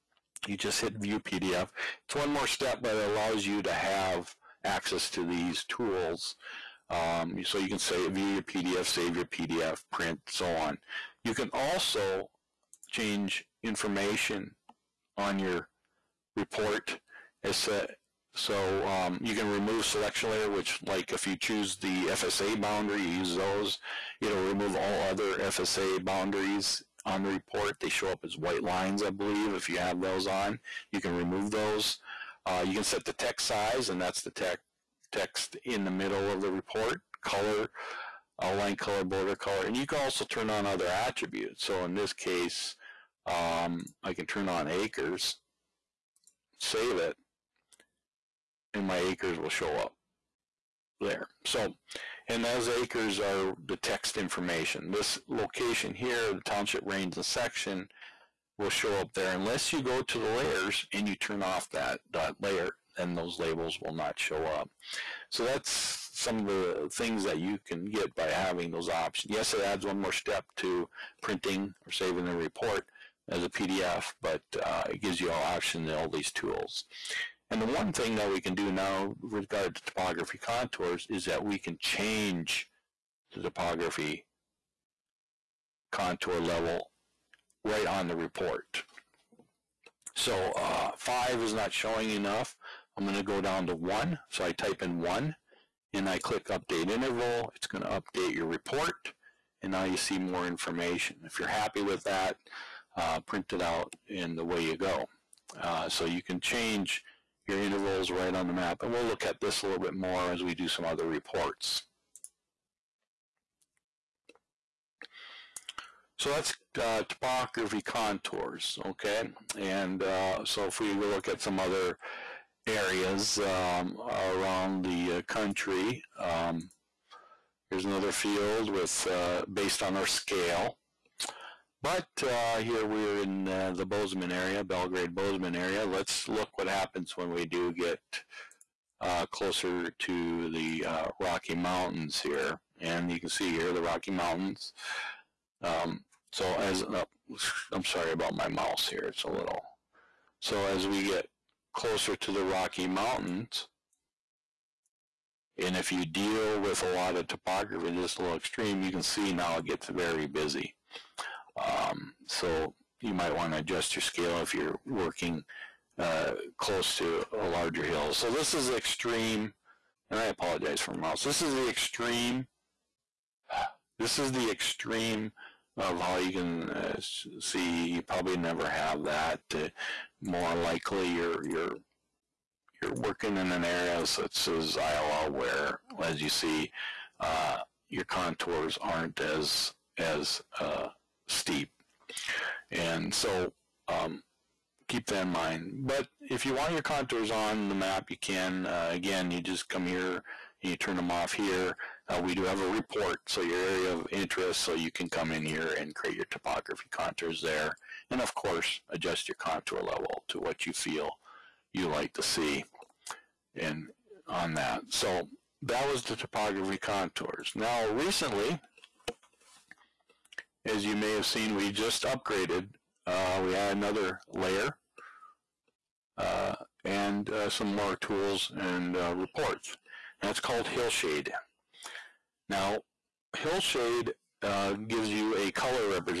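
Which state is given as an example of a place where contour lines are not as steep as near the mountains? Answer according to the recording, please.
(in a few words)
Iowa.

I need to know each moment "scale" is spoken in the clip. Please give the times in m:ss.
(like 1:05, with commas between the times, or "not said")
2:10, 2:44.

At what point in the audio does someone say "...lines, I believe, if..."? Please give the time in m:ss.
0:28.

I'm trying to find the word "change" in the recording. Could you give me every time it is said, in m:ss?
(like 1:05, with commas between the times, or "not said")
0:12, 1:21, 1:46.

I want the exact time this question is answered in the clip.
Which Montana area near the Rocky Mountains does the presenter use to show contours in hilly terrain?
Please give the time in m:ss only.
2:14.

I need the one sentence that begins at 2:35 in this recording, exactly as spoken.
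And if you deal with a lot of topography, just a little extreme, you can see now it gets very busy.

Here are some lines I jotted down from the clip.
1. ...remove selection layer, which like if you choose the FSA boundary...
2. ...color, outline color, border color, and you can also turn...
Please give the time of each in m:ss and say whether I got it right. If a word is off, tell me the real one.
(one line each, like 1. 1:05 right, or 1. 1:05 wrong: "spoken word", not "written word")
1. 0:19 right
2. 0:37 right.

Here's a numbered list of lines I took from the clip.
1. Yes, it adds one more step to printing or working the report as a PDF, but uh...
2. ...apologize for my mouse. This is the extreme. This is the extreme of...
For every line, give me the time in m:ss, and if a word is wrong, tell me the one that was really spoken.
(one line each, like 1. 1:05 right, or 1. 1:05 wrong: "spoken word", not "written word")
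1. 1:09 wrong: "saving", not "working"
2. 2:50 right.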